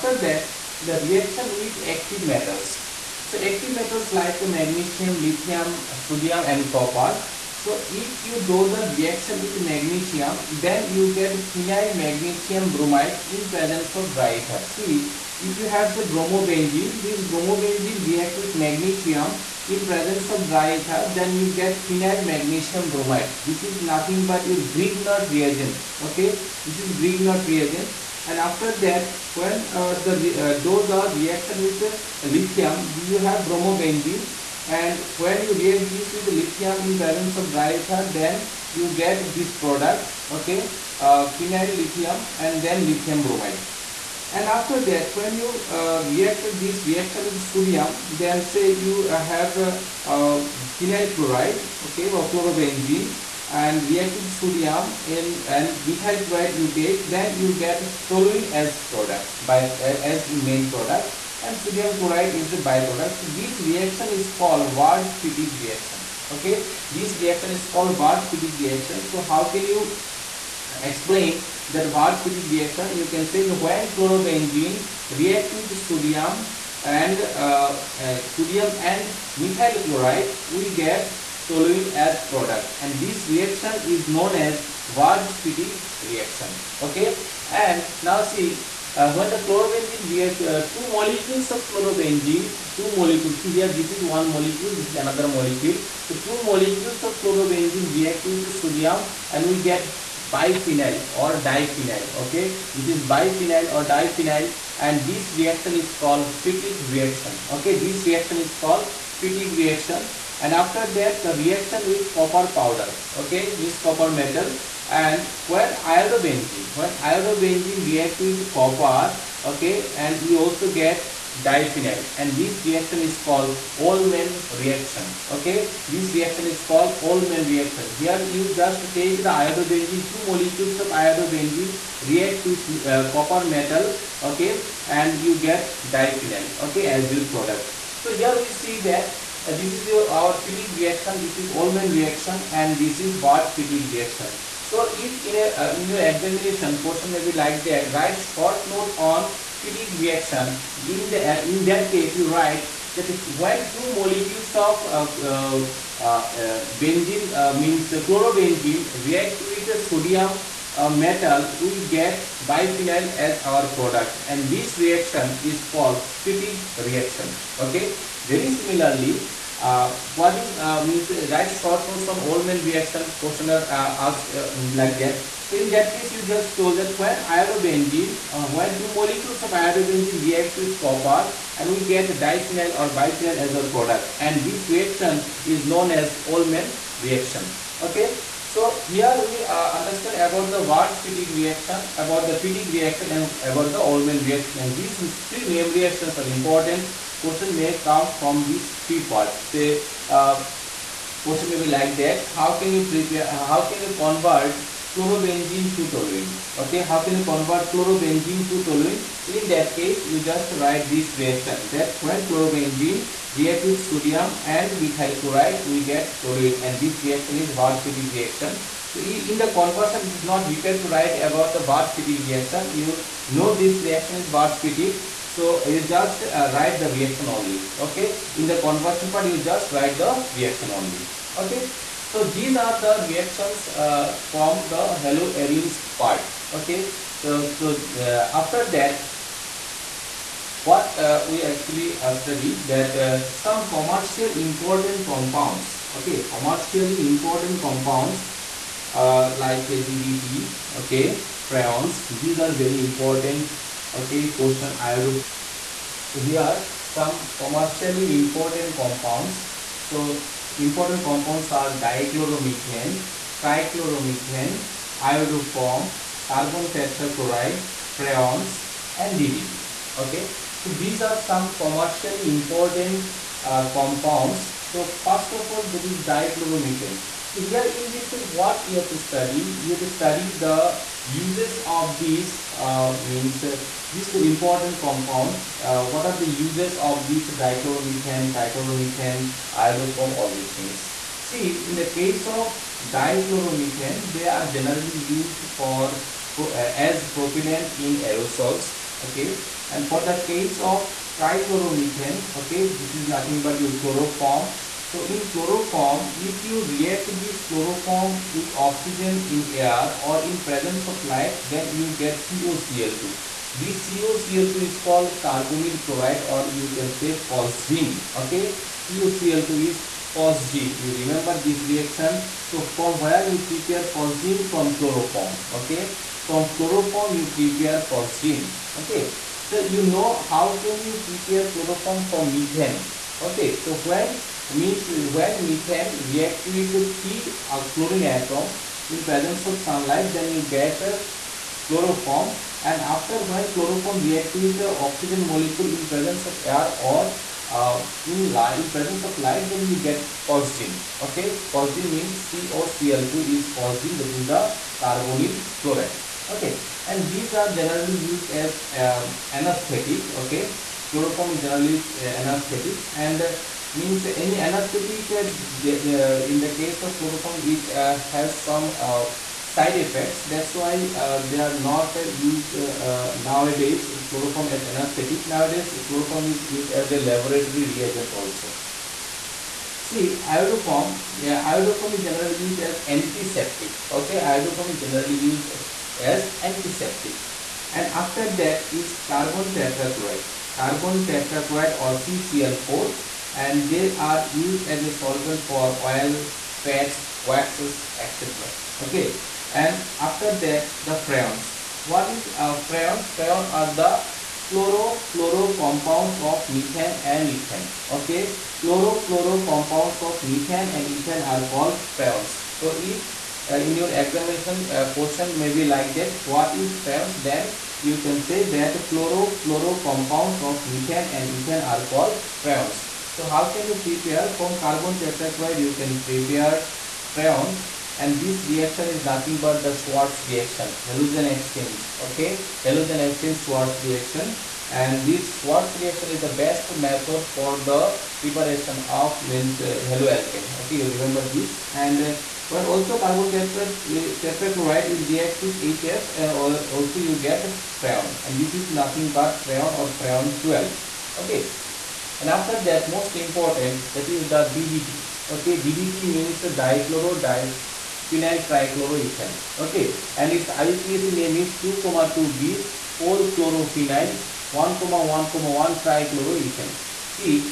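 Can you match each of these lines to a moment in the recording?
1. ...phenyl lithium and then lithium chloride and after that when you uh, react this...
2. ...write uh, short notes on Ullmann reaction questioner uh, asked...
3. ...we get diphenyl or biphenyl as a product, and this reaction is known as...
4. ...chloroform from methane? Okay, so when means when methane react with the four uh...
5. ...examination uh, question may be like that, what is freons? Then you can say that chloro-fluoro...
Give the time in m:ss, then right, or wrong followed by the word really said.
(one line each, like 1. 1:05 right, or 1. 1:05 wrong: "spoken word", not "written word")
1. 0:41 wrong: "bromide", not "chloride"
2. 2:51 right
3. 3:01 right
4. 5:31 wrong: "three", not "four"
5. 6:53 right.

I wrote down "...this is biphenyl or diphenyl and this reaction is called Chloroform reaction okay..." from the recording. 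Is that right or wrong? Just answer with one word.
wrong.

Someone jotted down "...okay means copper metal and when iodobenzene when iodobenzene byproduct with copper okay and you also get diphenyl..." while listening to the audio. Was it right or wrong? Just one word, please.
wrong.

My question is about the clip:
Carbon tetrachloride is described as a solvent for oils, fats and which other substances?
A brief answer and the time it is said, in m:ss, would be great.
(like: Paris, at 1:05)
waxes, at 6:37.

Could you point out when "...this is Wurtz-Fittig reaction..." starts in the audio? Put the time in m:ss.
2:22.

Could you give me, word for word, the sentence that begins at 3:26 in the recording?
Okay, how can you convert chlorobenzene to toluene?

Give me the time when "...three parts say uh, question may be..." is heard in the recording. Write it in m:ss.
3:18.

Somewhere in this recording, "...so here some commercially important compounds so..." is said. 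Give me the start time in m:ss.
4:16.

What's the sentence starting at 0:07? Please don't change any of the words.
So if you do the reaction with magnesium, then you get phenyl magnesium bromide in presence of dry ether.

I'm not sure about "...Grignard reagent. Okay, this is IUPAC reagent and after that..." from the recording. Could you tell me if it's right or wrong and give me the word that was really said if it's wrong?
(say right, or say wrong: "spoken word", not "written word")
wrong: "Grignard", not "IUPAC".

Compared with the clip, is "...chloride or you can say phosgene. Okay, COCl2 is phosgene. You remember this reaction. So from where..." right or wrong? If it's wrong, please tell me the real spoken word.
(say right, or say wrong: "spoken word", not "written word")
right.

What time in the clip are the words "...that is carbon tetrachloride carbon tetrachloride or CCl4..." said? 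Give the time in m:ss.
6:28.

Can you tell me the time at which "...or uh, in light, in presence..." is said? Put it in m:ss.
5:46.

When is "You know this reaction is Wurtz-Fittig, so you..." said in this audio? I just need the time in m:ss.
3:42.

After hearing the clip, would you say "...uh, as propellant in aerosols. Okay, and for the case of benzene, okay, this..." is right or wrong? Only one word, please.
wrong.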